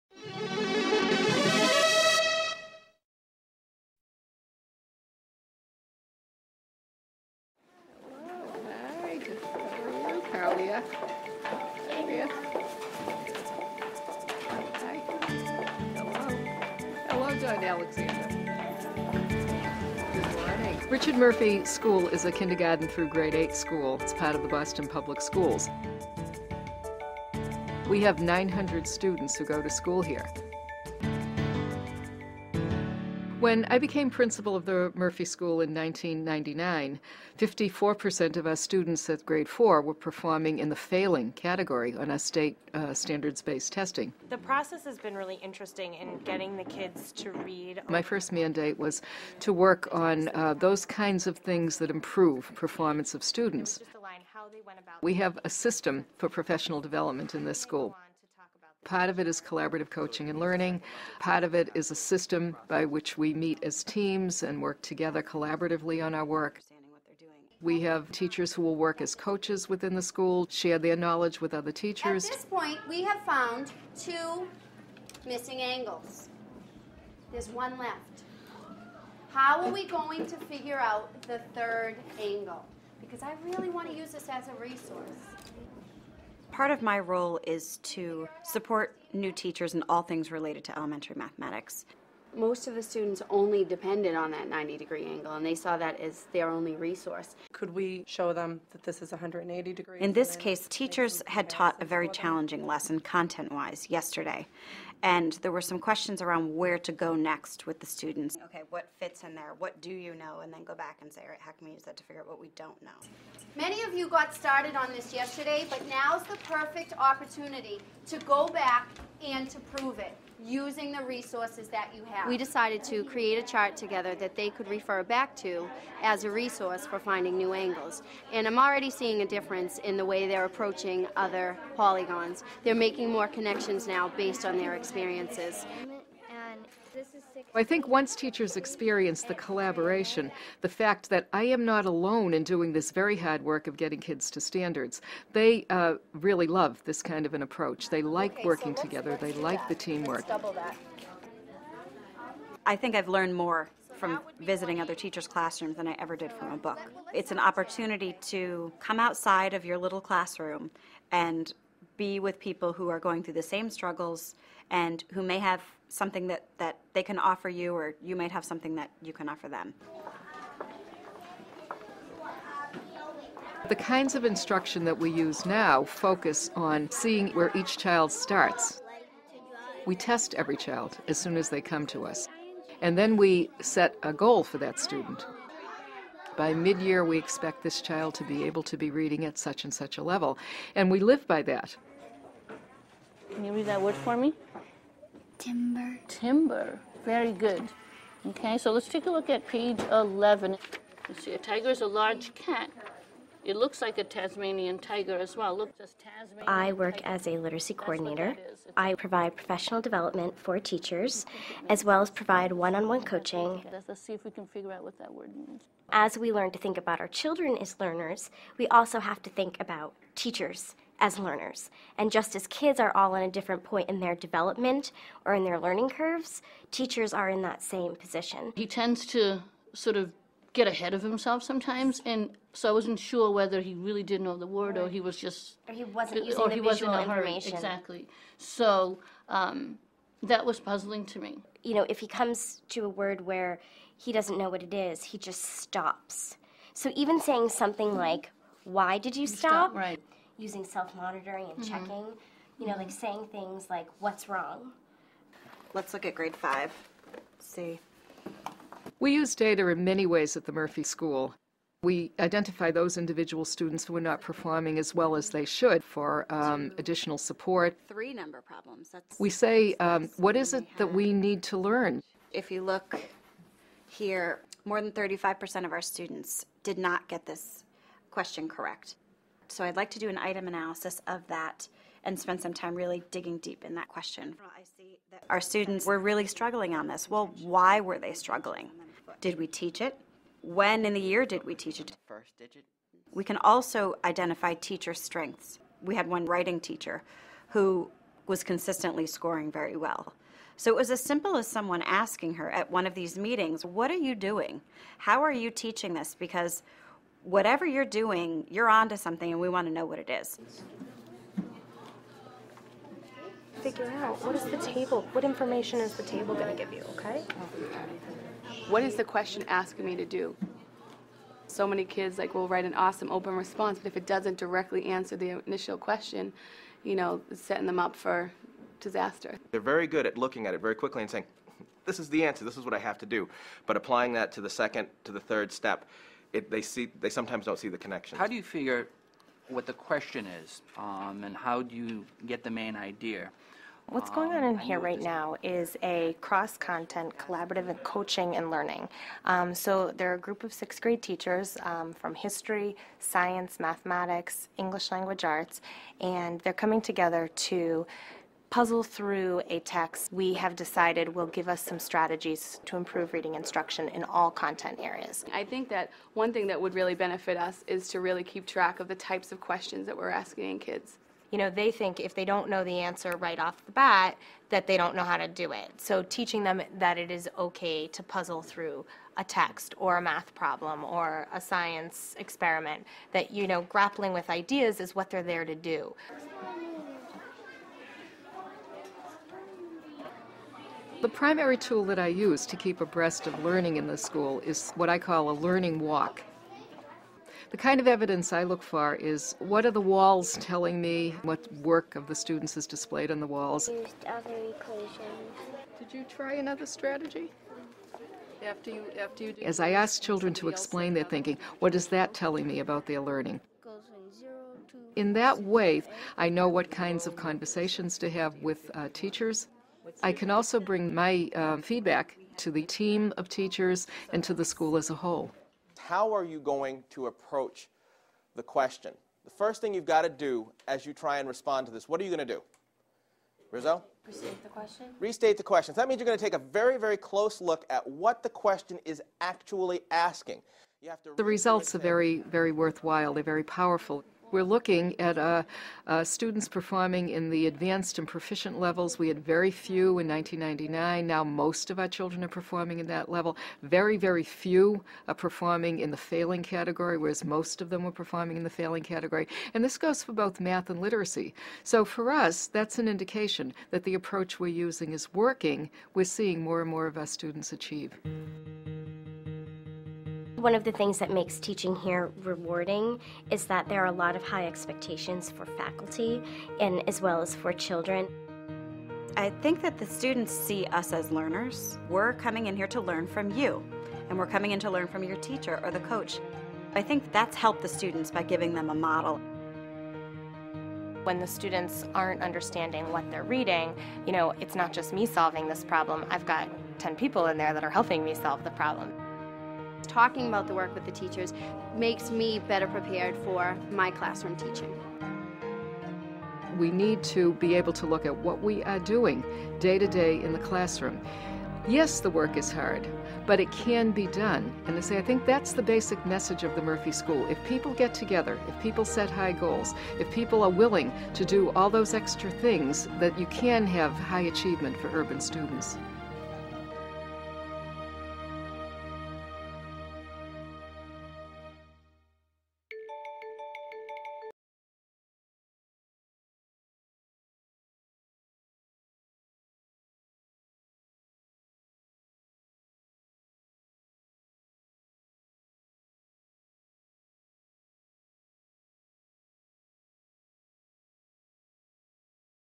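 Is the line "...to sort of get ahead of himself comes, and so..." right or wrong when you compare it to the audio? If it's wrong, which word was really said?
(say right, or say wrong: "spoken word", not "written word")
wrong: "sometimes", not "comes".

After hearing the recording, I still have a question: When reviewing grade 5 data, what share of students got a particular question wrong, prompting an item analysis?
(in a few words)
35%.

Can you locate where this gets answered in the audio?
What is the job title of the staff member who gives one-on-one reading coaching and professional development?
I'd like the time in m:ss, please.
3:27.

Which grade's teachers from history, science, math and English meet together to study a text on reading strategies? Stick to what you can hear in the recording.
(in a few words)
Sixth grade.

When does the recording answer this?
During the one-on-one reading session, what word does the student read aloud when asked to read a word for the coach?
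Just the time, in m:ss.
3:16.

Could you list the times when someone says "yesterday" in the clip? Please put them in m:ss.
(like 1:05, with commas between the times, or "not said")
1:43, 1:55.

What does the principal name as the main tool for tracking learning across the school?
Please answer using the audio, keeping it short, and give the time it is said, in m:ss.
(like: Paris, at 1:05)
Learning walk, at 6:35.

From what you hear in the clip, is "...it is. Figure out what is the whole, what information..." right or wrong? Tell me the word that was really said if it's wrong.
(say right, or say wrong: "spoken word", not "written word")
wrong: "table", not "whole".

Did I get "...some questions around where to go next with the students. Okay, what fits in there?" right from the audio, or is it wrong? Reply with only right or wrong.
right.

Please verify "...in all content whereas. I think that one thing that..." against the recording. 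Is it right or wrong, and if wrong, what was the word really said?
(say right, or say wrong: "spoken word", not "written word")
wrong: "areas", not "whereas".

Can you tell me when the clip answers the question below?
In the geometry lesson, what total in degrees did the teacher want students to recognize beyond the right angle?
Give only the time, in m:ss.
1:39.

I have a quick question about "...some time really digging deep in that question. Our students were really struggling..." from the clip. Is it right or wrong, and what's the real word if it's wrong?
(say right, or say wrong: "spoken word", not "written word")
right.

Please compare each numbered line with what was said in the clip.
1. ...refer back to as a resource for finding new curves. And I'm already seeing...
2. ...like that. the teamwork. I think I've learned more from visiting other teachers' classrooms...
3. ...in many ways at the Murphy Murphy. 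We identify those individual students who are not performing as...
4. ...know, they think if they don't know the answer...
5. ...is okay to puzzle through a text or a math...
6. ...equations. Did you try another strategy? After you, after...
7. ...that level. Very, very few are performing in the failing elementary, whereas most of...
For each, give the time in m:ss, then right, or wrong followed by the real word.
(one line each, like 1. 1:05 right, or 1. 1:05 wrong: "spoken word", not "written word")
1. 2:04 wrong: "angles", not "curves"
2. 2:29 right
3. 4:19 wrong: "School", not "Murphy"
4. 6:11 right
5. 6:17 right
6. 6:44 right
7. 7:32 wrong: "category", not "elementary".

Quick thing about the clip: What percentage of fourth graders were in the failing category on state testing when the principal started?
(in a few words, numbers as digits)
54%.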